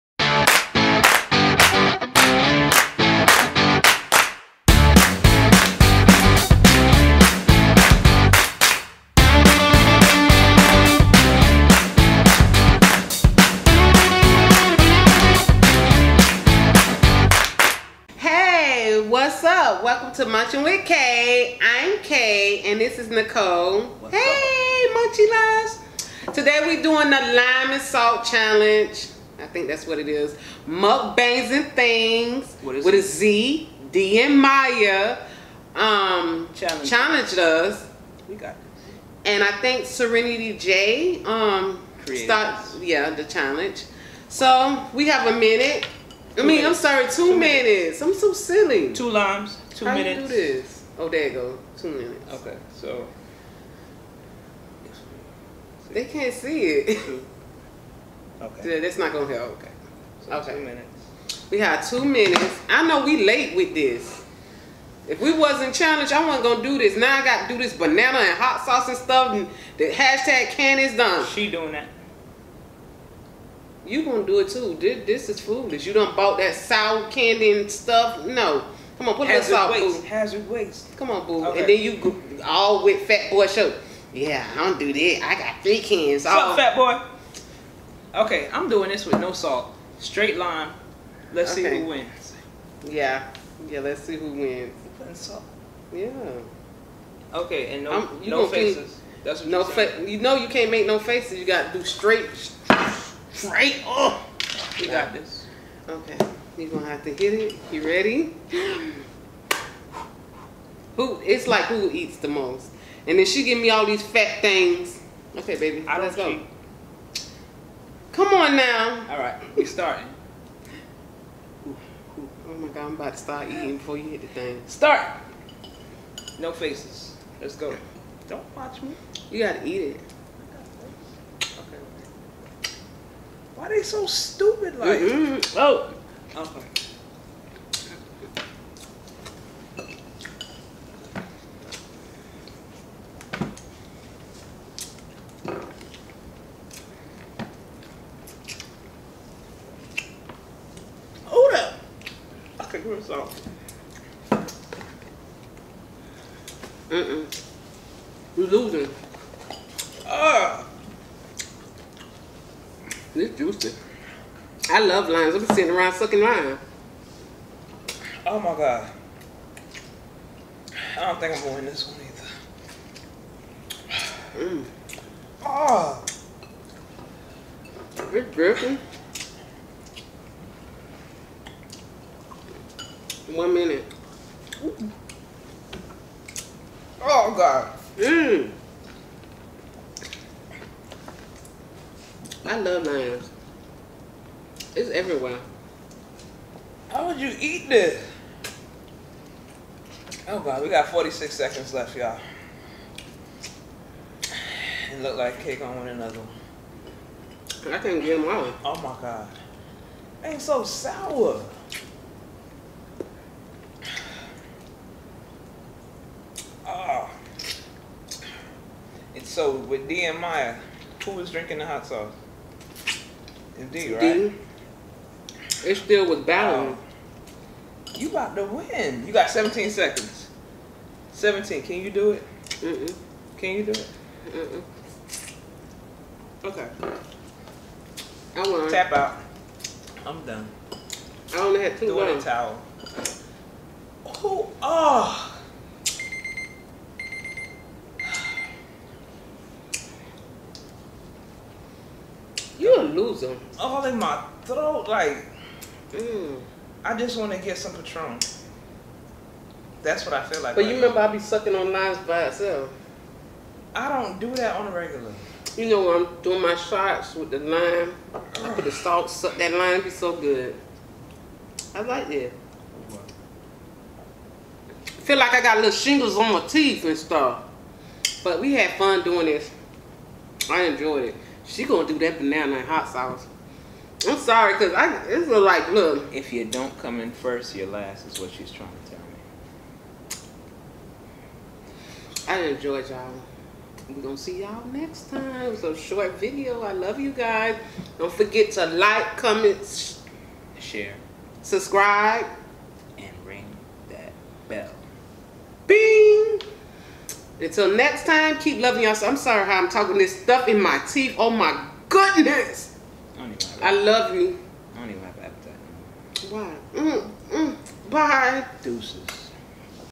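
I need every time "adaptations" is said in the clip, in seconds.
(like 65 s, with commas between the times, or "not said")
not said.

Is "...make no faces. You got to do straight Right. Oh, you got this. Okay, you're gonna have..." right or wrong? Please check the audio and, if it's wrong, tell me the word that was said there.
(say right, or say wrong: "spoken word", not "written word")
right.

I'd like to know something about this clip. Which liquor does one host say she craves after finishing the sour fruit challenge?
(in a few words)
Patron.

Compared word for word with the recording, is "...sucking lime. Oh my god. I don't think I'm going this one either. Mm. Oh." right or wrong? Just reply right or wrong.
right.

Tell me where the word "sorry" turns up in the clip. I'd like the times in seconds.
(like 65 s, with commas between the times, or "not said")
46 s, 284 s, 309 s.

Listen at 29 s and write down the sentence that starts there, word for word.
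I think that's what it is.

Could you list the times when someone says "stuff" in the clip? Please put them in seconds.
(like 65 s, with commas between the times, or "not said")
68 s, 77 s, 276 s, 310 s.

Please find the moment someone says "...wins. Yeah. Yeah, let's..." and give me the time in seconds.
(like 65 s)
91 s.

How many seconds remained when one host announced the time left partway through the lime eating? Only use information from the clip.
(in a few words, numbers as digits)
46.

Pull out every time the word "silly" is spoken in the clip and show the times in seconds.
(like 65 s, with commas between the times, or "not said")
48 s.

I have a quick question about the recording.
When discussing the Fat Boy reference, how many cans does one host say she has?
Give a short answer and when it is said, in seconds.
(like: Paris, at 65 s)
3, at 85 s.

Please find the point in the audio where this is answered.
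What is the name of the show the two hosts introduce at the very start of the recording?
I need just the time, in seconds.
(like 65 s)
20 s.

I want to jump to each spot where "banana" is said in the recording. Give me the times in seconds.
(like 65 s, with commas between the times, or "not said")
67 s, 282 s.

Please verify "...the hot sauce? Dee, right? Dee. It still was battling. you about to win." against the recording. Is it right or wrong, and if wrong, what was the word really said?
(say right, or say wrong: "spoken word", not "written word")
right.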